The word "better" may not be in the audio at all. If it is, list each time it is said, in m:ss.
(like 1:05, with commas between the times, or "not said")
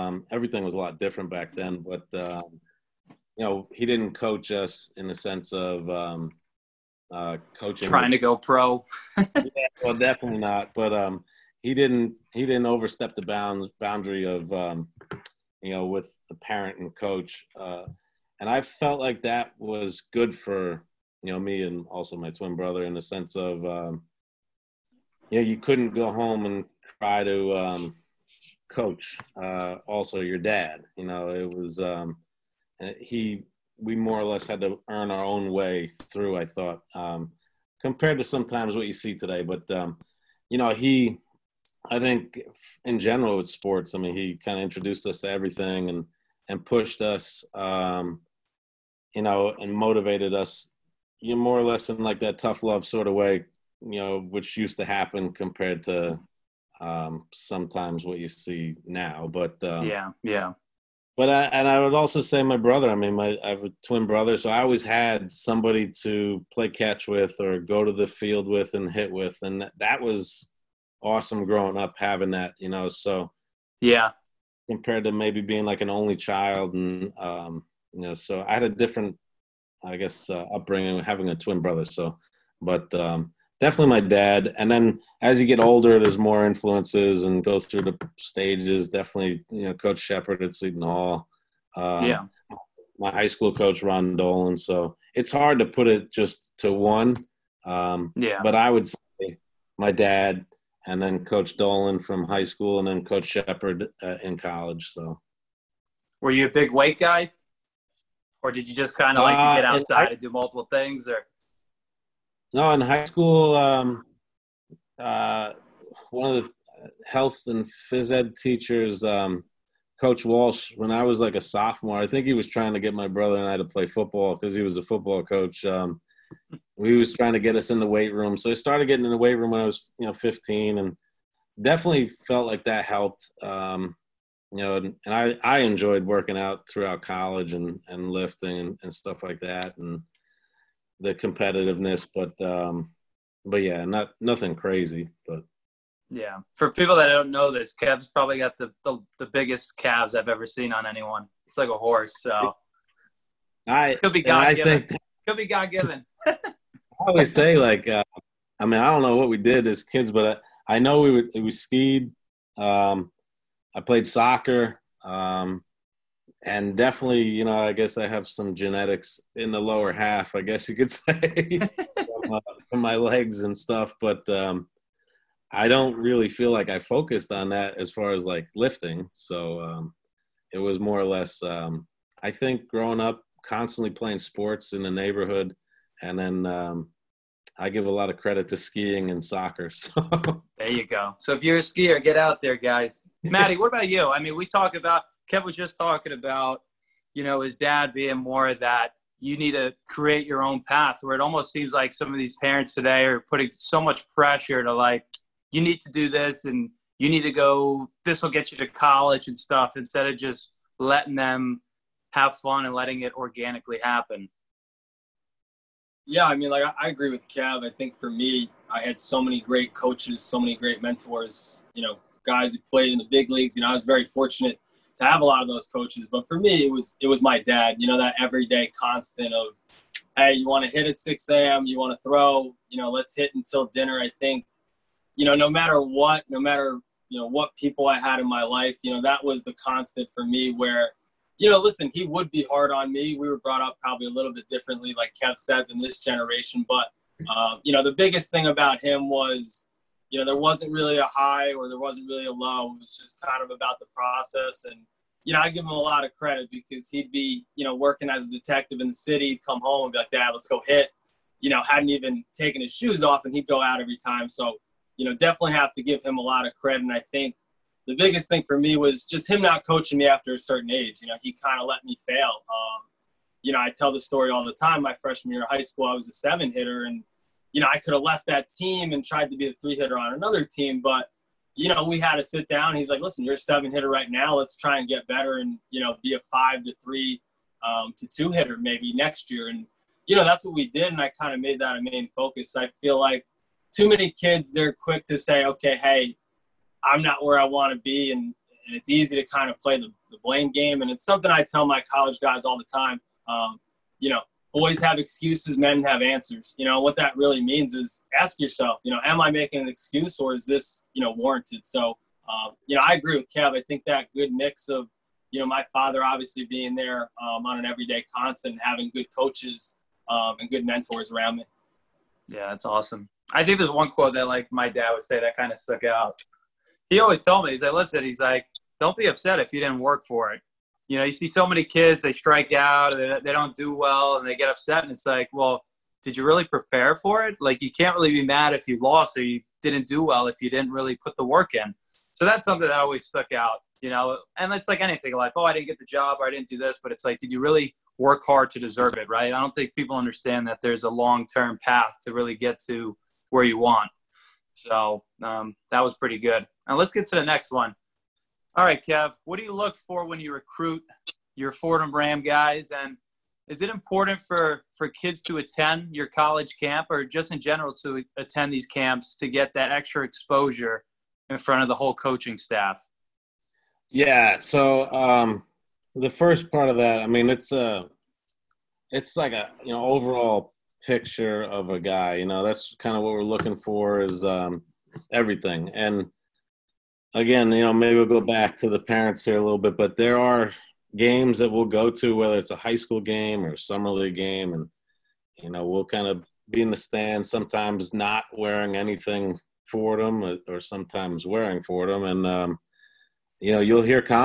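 4:45.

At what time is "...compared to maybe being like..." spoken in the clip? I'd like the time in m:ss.
1:14.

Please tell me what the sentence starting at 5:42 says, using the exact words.
So that's something that always stuck out, you know.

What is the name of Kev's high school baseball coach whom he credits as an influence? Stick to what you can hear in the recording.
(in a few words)
Ron Dolan.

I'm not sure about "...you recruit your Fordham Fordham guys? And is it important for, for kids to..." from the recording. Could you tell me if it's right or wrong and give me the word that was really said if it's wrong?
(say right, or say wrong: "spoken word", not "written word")
wrong: "Ram", not "Fordham".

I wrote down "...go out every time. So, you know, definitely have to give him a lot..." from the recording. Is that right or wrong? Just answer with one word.
right.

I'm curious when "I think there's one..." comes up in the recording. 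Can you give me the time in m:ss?
5:23.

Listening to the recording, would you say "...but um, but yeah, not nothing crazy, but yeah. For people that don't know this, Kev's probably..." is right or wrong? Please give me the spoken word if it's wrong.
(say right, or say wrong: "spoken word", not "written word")
right.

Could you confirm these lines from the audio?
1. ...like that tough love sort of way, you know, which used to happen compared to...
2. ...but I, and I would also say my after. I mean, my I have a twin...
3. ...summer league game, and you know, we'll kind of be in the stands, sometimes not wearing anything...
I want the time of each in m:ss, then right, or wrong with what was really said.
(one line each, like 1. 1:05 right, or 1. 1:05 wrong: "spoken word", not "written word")
1. 0:51 right
2. 1:01 wrong: "brother", not "after"
3. 6:33 right.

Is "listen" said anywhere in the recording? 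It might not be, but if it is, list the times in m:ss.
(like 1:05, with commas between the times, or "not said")
4:01, 4:42, 5:27.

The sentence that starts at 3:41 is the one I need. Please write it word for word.
You know, guys who played in the big leagues.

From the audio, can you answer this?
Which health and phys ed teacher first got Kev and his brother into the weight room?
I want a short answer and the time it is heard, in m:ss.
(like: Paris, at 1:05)
Coach Walsh, at 1:59.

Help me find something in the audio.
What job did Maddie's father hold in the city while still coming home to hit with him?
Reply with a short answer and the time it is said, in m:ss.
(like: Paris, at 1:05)
Detective, at 4:18.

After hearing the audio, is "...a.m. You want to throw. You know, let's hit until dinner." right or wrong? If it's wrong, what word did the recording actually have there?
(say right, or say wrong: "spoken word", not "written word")
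right.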